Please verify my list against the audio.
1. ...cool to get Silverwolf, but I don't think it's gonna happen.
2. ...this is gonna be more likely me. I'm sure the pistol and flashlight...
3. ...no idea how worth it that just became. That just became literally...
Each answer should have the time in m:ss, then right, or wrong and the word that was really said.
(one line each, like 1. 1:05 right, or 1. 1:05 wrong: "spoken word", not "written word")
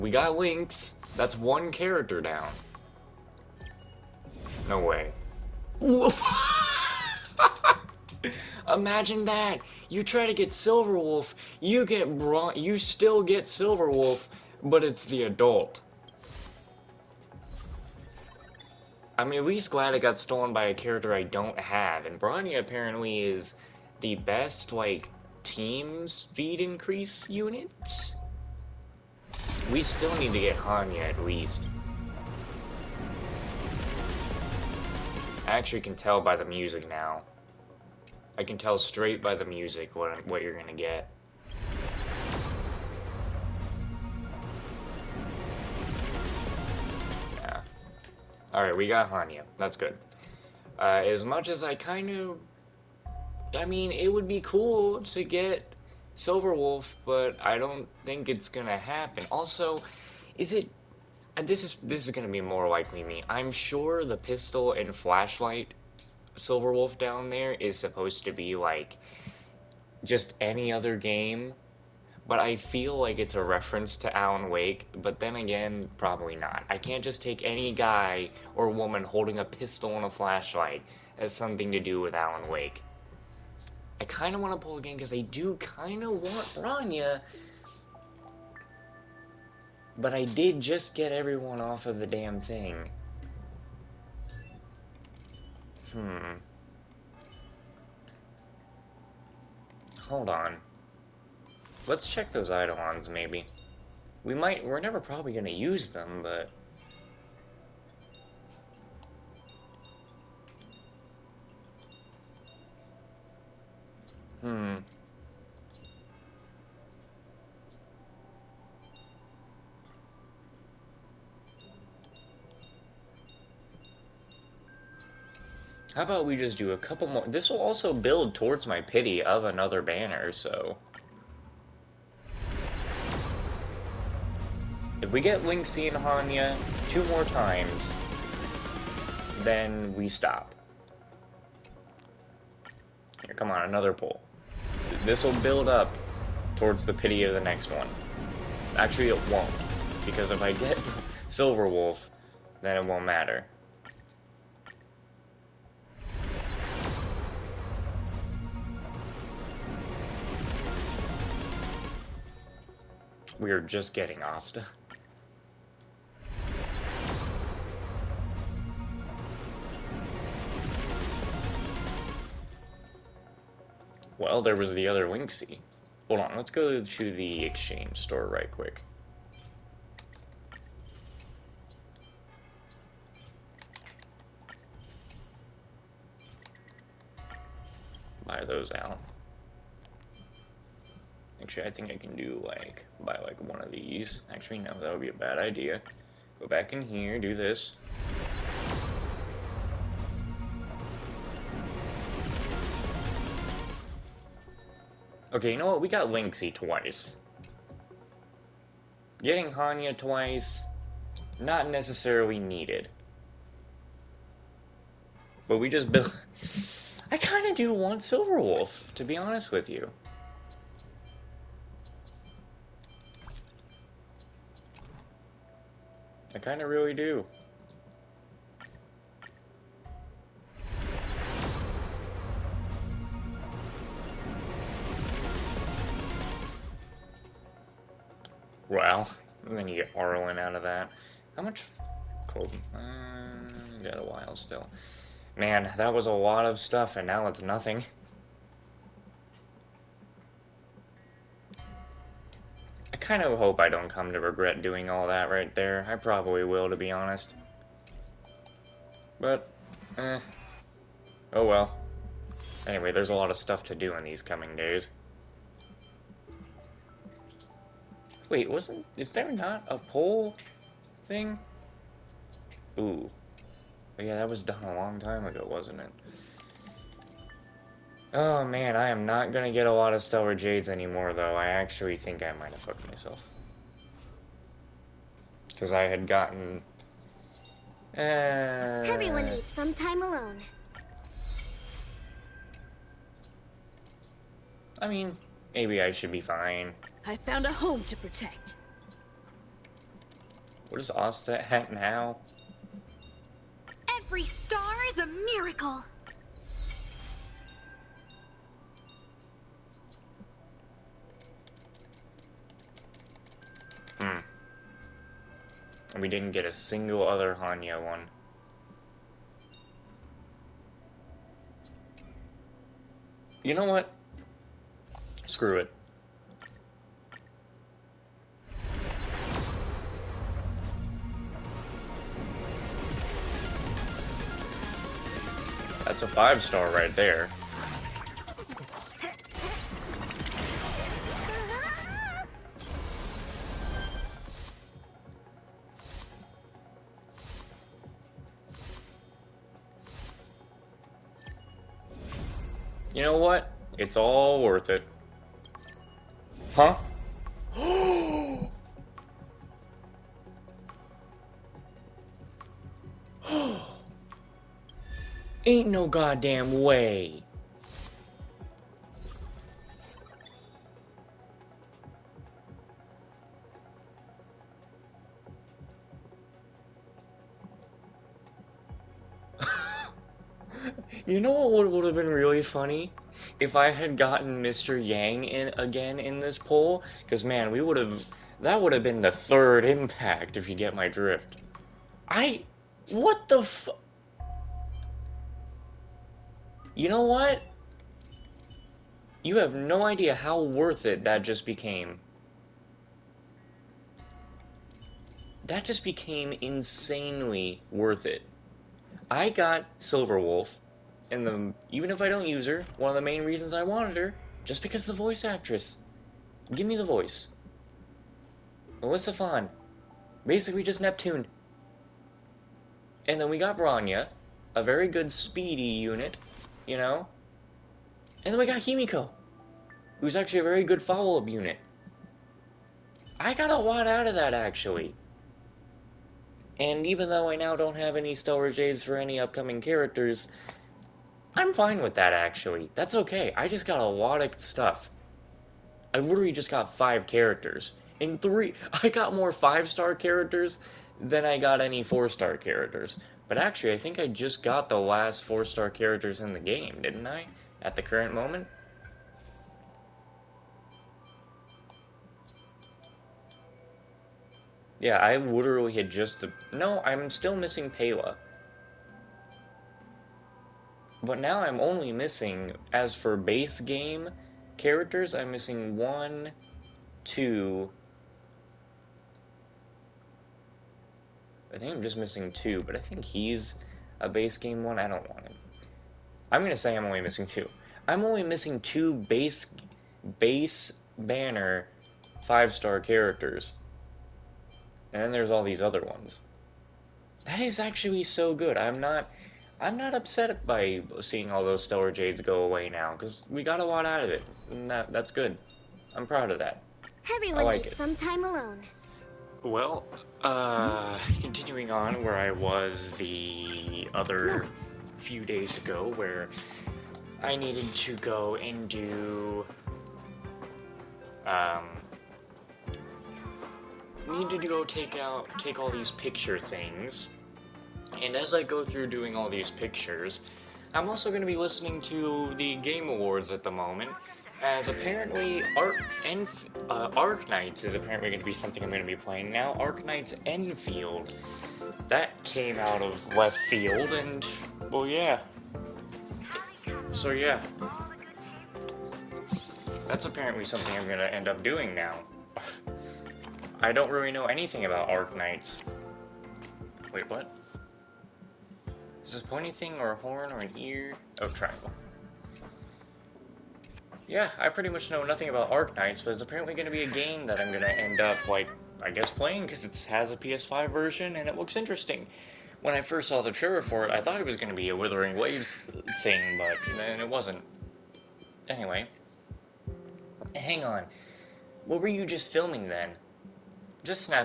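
1. 0:54 right
2. 1:01 right
3. 6:39 wrong: "insanely", not "literally".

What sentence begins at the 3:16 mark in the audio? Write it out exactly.
Go back in here, do this.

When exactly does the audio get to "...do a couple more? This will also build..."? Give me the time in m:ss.
2:06.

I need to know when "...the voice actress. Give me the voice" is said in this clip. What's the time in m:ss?
6:54.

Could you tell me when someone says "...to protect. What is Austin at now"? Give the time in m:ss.
4:57.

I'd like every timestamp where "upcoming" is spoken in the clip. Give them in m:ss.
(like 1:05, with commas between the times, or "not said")
7:19.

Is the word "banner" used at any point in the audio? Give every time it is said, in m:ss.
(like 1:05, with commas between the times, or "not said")
2:09, 8:10.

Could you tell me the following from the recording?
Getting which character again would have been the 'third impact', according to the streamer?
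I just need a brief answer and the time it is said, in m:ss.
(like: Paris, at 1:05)
Mr. Yang, at 6:24.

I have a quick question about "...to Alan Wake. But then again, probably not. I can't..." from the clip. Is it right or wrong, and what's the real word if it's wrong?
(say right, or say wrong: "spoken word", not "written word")
right.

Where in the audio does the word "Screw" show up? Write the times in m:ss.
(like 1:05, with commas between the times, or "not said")
5:25.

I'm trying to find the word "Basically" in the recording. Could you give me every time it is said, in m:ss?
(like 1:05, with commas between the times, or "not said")
7:00.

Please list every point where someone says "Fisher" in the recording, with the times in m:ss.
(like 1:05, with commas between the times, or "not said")
not said.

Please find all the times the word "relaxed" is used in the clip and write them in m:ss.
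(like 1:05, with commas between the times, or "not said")
not said.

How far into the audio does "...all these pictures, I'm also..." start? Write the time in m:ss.
8:49.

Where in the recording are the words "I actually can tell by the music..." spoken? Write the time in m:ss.
0:35.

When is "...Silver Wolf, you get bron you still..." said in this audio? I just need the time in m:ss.
0:10.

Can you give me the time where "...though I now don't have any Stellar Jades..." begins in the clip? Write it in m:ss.
7:17.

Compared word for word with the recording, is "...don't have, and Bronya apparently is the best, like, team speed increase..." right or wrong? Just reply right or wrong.
right.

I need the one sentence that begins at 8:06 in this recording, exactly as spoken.
I'm gonna say I'm only missing two.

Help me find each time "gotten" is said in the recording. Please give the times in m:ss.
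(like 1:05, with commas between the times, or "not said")
4:46, 6:23.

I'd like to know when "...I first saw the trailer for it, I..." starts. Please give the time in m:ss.
9:32.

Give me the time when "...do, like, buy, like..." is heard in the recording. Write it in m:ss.
3:12.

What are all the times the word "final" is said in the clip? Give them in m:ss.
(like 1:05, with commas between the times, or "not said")
not said.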